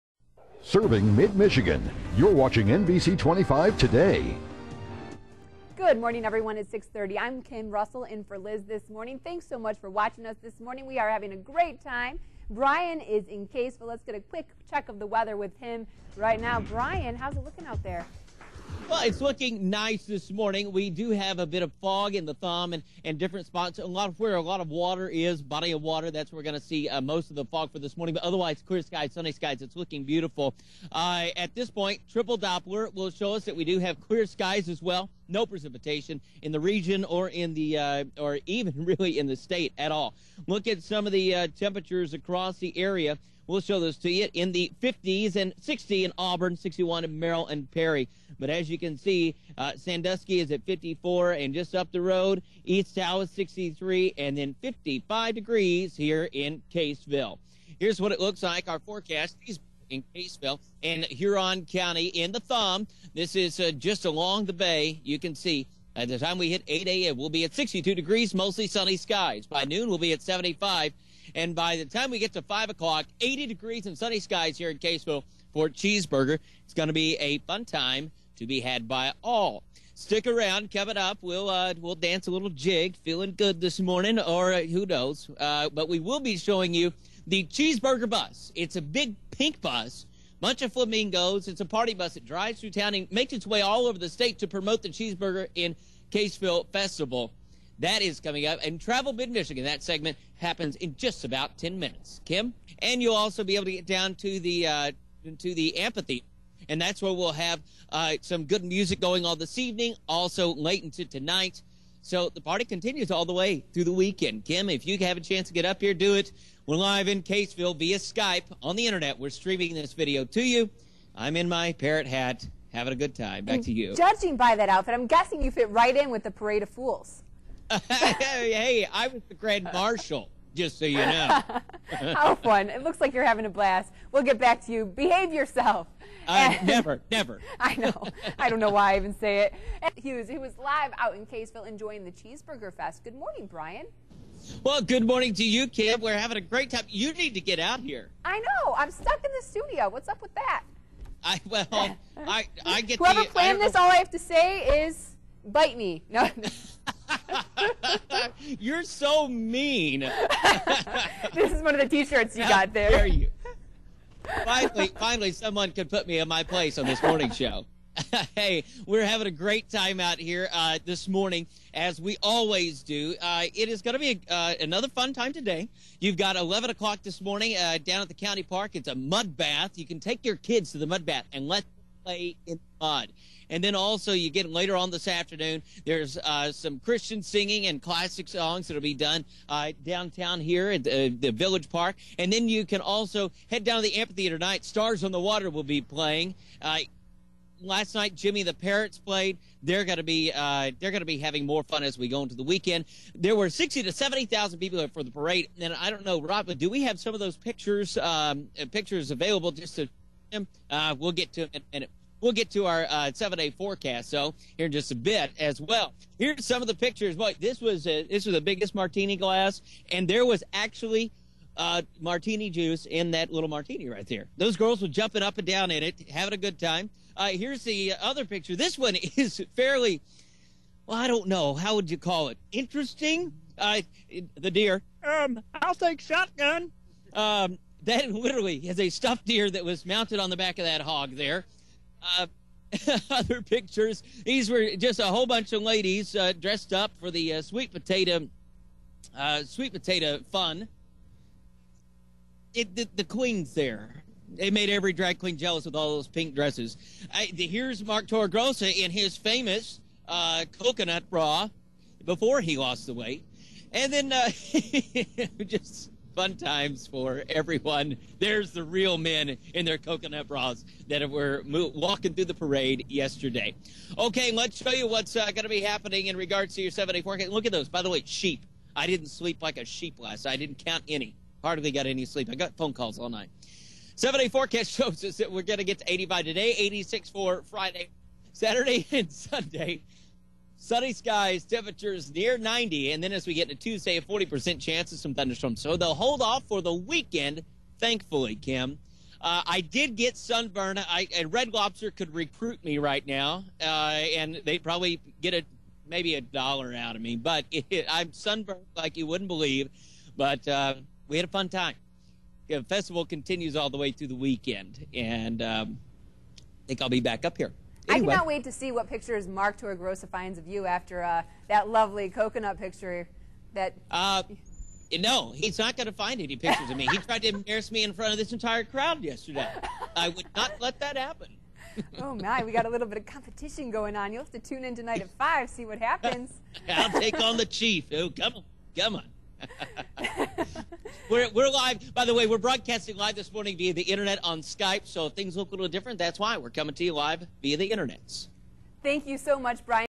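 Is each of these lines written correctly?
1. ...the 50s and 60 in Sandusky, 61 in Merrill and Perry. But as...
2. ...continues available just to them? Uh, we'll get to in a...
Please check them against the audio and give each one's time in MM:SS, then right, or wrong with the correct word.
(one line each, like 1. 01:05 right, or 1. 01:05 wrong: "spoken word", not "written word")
1. 00:44 wrong: "Auburn", not "Sandusky"
2. 03:28 wrong: "pictures", not "continues".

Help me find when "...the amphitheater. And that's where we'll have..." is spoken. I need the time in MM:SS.
01:45.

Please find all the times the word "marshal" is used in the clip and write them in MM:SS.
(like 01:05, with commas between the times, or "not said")
02:09.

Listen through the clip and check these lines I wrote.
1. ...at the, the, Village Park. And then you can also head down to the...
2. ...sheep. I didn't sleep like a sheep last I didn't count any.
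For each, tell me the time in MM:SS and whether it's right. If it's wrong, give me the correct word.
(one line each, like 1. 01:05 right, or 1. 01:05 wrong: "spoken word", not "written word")
1. 03:10 right
2. 04:38 right.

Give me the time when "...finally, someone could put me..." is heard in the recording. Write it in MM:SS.
02:44.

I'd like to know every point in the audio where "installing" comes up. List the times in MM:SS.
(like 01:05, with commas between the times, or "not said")
not said.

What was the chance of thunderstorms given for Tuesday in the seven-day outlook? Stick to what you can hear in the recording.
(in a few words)
40%.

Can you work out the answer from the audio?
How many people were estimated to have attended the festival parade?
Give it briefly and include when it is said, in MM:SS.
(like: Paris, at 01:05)
60,000 to 70,000, at 03:23.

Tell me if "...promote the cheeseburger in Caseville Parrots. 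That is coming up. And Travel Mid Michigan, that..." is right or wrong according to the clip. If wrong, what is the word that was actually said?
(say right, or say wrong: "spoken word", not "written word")
wrong: "Festival", not "Parrots".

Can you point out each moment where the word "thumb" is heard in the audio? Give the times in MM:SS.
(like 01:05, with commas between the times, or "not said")
00:22, 01:02.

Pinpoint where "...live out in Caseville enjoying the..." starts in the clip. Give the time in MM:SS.
02:20.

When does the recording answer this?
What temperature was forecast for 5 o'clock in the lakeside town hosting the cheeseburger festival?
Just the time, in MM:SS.
01:13.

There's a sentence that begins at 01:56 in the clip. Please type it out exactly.
We're live in Caseville via Skype on the internet.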